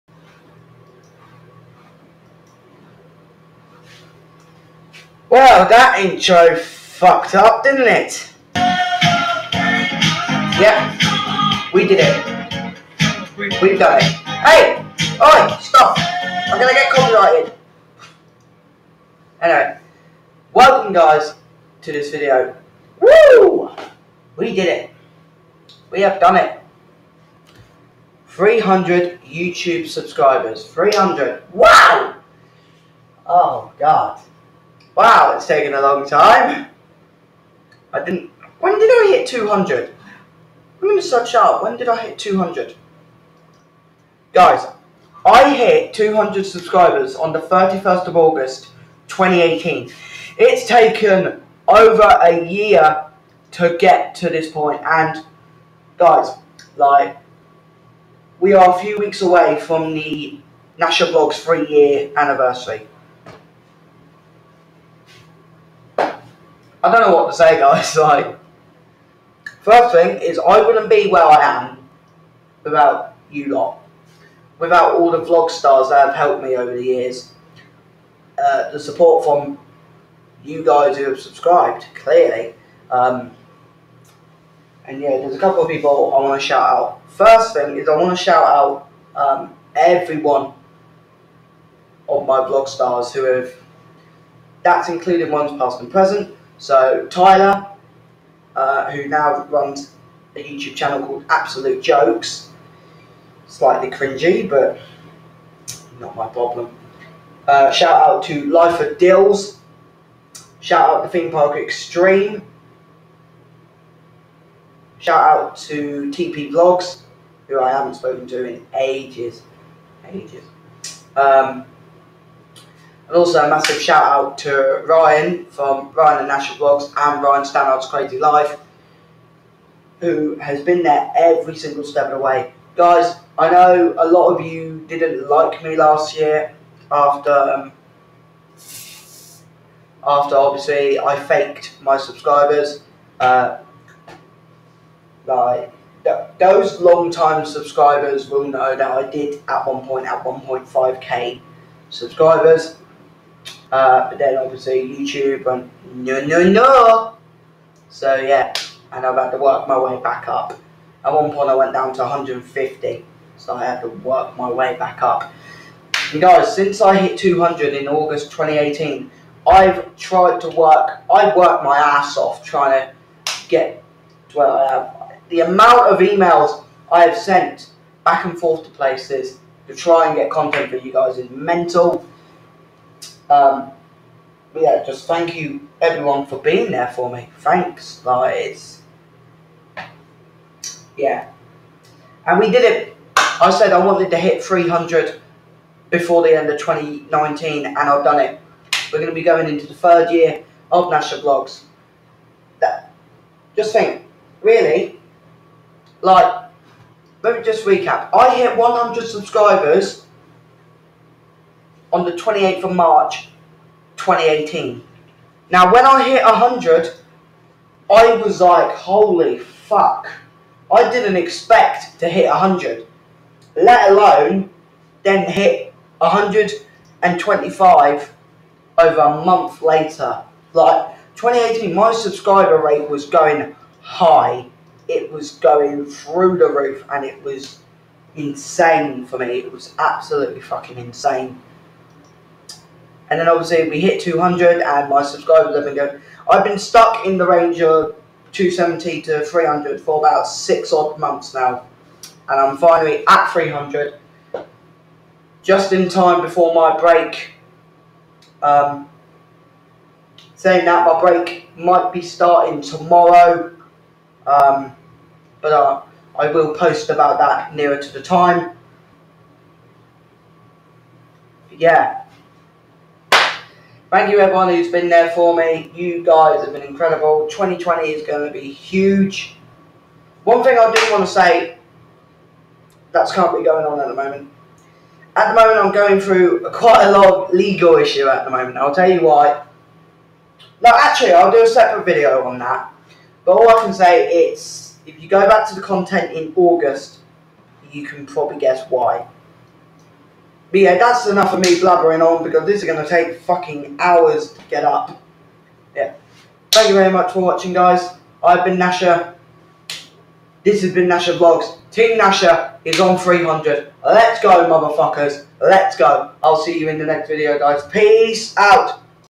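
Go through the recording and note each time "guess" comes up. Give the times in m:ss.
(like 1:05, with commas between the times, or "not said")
4:58.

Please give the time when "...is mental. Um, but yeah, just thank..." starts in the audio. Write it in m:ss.
3:01.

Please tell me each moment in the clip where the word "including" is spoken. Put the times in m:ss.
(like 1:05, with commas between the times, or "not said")
1:34.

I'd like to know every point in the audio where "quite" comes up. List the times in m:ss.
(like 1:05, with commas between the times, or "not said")
4:46.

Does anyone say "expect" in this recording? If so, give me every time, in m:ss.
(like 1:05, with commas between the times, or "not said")
3:41.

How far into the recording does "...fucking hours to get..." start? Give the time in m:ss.
5:03.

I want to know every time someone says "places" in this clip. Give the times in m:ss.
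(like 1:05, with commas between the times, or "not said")
2:58.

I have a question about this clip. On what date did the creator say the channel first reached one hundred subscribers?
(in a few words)
28 March 2018.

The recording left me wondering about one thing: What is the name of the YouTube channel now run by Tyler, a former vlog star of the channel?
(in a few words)
Absolute Jokes.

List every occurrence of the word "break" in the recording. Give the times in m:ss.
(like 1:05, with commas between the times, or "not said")
4:16, 4:21.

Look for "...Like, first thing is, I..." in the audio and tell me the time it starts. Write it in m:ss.
1:07.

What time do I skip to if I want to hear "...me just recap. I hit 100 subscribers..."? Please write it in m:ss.
3:27.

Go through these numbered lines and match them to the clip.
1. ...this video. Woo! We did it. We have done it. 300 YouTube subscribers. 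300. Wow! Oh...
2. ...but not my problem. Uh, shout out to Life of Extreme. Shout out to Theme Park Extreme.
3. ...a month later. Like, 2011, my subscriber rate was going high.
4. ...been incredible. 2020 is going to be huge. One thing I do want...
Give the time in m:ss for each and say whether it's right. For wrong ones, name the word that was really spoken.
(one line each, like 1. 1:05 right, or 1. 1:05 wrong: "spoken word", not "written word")
1. 0:21 right
2. 1:44 wrong: "Dylz", not "Extreme"
3. 3:49 wrong: "2018", not "2011"
4. 4:36 right.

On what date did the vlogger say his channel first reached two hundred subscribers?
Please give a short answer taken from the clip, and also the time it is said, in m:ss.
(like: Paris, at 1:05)
31 August 2018, at 0:47.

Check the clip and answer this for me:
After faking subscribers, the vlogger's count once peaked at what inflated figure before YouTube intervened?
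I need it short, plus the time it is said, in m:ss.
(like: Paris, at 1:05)
1.5k, at 2:30.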